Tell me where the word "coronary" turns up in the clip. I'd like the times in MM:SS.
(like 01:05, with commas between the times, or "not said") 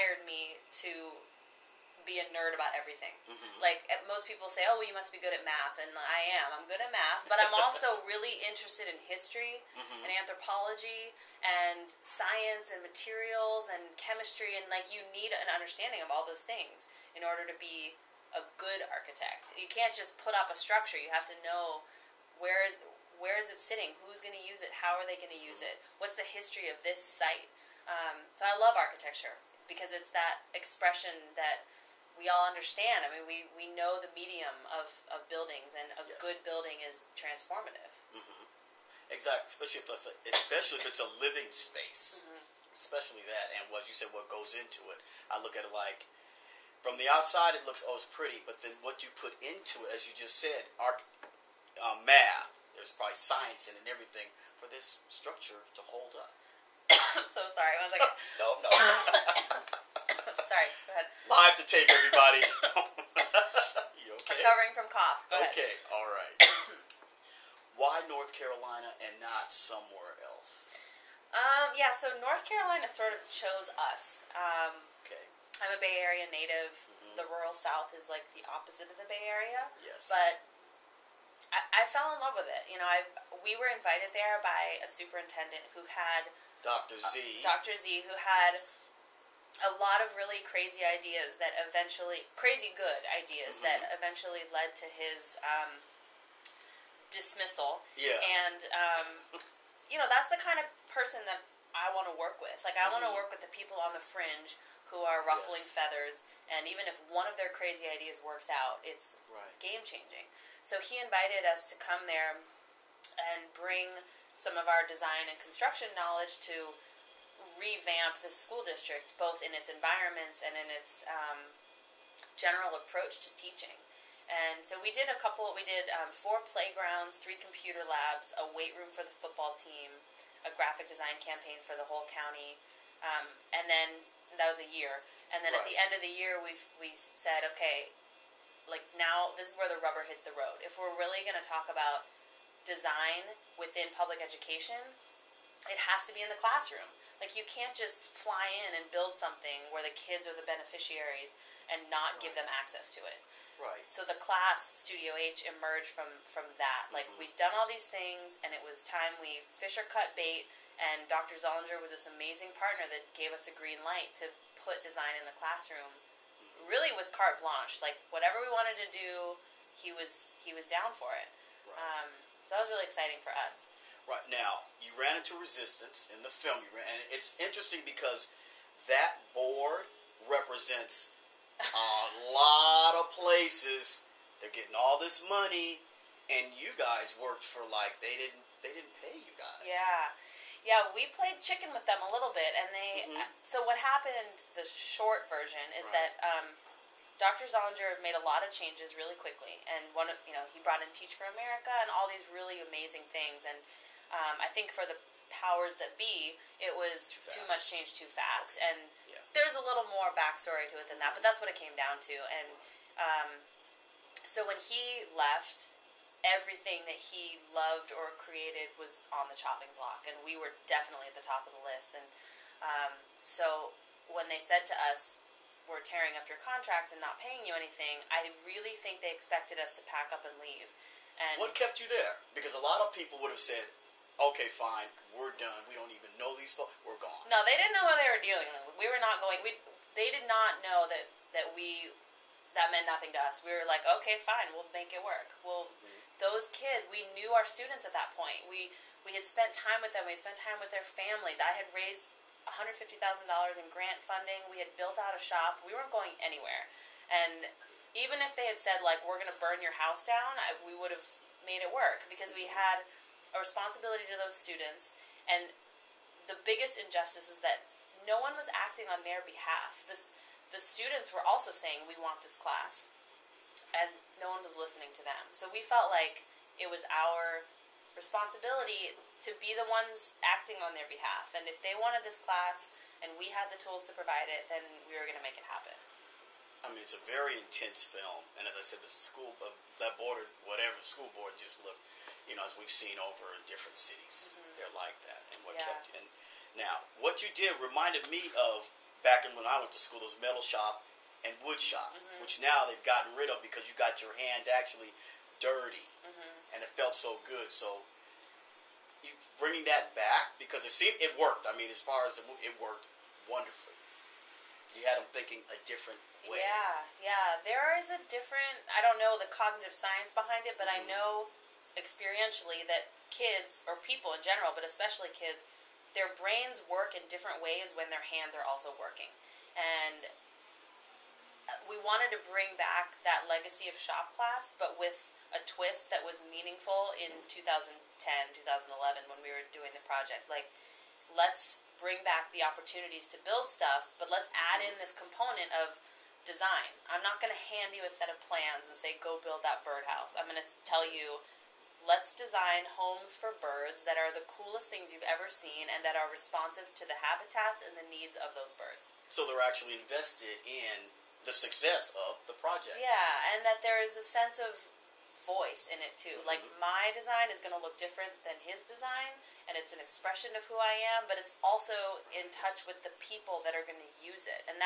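not said.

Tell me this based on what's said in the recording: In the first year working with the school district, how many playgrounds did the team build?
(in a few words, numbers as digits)
4.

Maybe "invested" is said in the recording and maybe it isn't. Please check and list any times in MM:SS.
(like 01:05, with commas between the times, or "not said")
05:59.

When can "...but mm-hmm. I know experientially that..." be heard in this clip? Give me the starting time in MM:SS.
05:20.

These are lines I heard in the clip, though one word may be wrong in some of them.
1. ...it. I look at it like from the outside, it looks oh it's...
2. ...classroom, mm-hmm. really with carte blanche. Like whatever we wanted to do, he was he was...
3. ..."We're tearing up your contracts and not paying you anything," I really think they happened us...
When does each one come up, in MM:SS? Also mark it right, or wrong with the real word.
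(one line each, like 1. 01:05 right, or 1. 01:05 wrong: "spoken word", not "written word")
1. 00:44 right
2. 02:45 right
3. 03:45 wrong: "expected", not "happened".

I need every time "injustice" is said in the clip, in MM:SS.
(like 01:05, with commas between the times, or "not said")
04:26.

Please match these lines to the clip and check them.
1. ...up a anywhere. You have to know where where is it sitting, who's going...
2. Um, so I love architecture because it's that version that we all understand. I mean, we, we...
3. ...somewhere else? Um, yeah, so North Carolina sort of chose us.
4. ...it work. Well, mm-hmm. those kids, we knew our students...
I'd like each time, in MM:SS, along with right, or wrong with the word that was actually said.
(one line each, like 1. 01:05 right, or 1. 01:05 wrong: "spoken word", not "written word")
1. 00:20 wrong: "structure", not "anywhere"
2. 00:27 wrong: "expression", not "version"
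3. 01:09 right
4. 04:04 right.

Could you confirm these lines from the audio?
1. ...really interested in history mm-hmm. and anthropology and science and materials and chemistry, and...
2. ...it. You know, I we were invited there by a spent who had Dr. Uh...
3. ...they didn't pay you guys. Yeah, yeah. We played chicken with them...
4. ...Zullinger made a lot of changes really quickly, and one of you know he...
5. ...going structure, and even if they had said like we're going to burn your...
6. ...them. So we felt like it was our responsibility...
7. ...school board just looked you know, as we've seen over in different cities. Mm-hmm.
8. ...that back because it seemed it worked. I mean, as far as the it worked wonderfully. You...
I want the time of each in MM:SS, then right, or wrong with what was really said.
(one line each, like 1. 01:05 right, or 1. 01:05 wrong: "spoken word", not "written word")
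1. 00:08 right
2. 01:22 wrong: "superintendent", not "spent"
3. 03:08 right
4. 03:17 right
5. 04:15 wrong: "anywhere", not "structure"
6. 04:35 right
7. 04:50 right
8. 05:09 right.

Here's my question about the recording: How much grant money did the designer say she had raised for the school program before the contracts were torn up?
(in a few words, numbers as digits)
$150,000.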